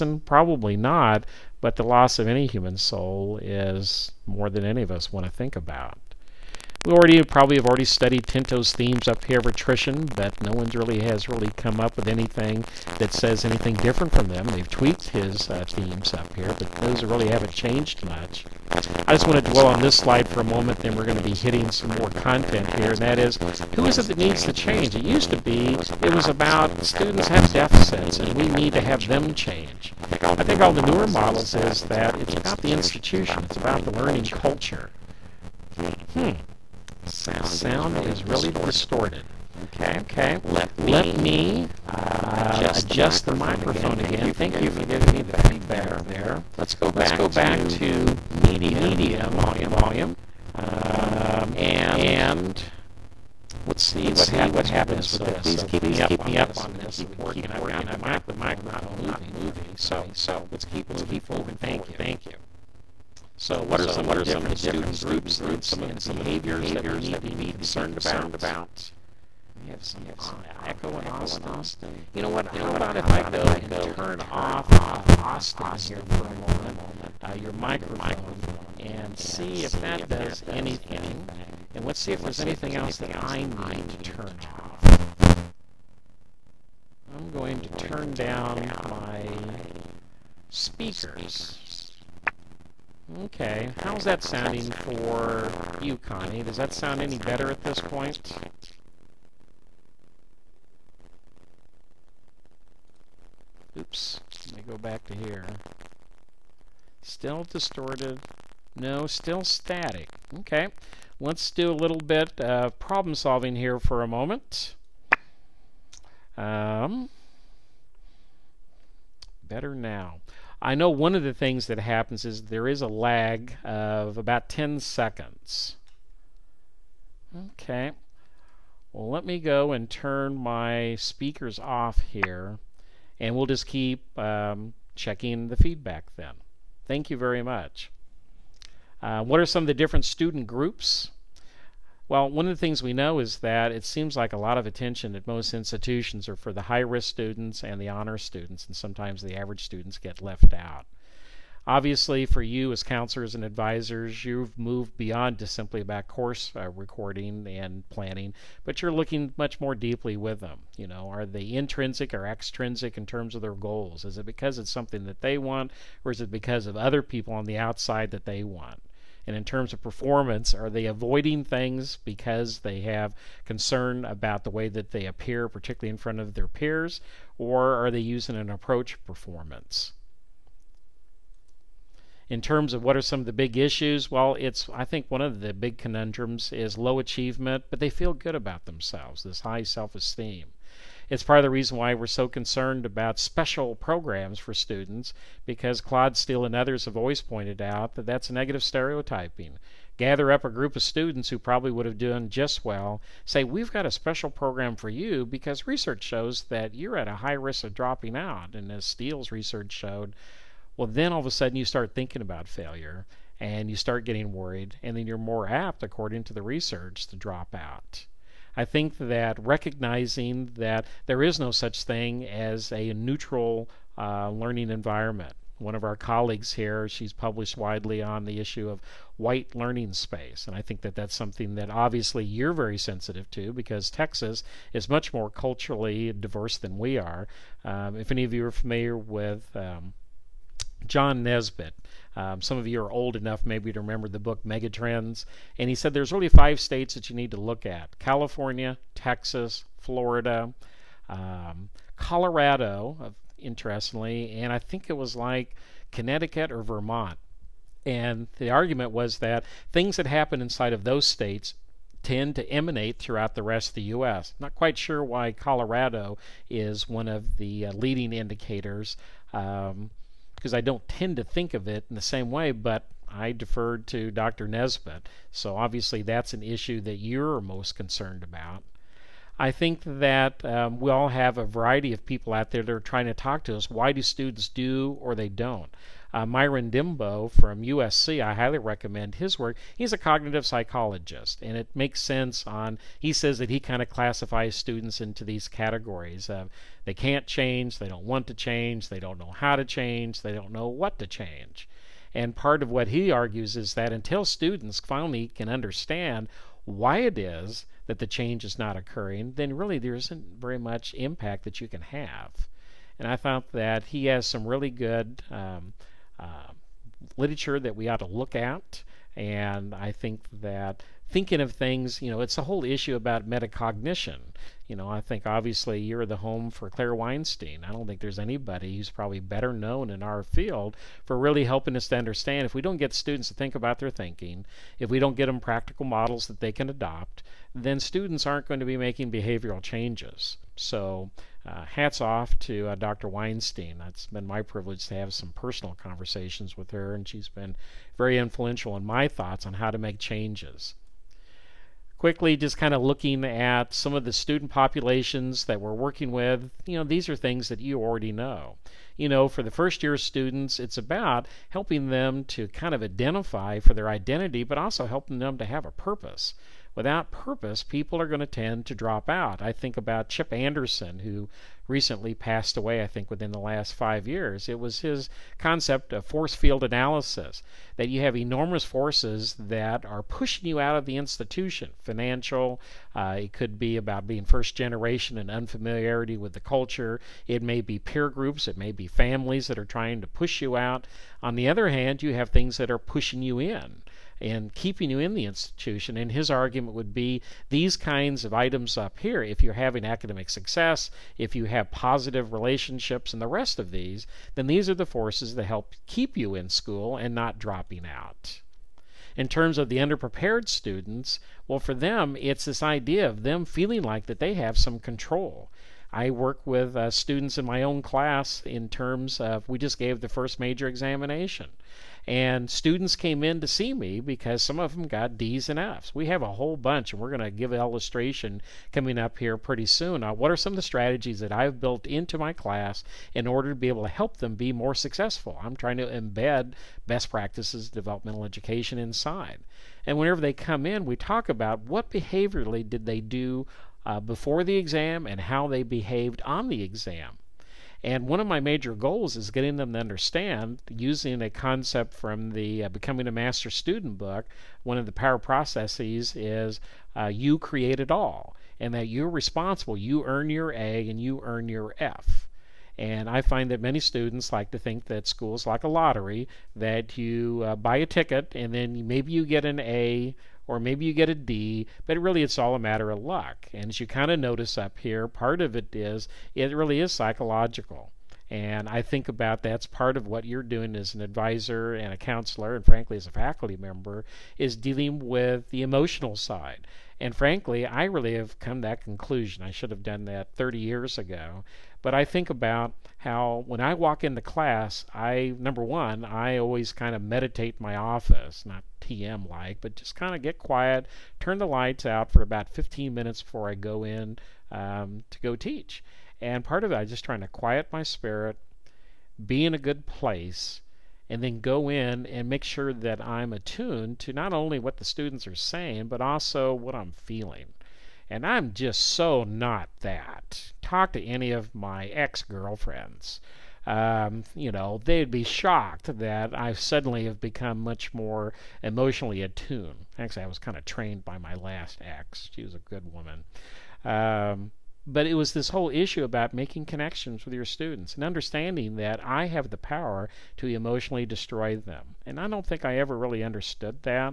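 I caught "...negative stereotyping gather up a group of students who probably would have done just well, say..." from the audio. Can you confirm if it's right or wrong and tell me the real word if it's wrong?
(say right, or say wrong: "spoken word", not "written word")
right.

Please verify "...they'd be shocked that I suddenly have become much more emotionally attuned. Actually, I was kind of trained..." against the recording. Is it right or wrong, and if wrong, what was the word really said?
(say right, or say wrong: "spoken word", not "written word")
right.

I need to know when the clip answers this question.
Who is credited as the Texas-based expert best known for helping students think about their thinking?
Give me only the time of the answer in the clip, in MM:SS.
05:26.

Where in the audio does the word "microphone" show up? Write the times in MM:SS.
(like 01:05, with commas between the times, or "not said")
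00:43, 01:17.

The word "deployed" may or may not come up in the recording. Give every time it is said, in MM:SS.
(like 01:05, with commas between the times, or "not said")
not said.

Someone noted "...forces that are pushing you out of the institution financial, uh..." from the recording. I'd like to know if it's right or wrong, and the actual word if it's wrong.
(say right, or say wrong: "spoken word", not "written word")
right.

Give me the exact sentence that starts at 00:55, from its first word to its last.
Please keep, me, up keep me up on this.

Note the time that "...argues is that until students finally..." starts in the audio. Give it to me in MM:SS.
05:03.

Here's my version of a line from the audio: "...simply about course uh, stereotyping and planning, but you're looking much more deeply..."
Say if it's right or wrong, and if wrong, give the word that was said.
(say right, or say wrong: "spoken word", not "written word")
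wrong: "recording", not "stereotyping".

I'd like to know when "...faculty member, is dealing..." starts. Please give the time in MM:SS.
08:03.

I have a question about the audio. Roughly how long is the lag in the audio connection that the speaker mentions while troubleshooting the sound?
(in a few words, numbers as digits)
10 seconds.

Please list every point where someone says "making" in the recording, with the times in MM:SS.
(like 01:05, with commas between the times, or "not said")
05:38, 08:56.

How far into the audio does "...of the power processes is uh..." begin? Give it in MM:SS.
07:34.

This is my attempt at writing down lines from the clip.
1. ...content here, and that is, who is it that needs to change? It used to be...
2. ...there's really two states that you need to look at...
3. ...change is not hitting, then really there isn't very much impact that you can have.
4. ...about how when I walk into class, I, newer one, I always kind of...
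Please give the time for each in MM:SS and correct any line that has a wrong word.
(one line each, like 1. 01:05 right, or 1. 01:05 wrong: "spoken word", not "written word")
1. 00:22 right
2. 04:05 wrong: "five", not "two"
3. 05:08 wrong: "occurring", not "hitting"
4. 08:12 wrong: "number", not "newer".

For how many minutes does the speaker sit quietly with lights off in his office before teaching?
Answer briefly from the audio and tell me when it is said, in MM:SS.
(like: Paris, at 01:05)
15, at 08:22.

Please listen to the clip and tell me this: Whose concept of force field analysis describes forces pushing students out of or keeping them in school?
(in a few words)
Chip Anderson.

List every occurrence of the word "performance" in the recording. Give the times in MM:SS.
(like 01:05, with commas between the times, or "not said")
02:49, 02:59.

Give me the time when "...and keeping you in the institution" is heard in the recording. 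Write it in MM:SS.
06:34.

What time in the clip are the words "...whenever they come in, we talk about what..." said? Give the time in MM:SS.
07:19.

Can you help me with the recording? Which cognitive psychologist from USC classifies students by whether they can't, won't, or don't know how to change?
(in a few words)
Myron Dembo.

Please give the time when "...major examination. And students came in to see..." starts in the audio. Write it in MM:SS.
07:00.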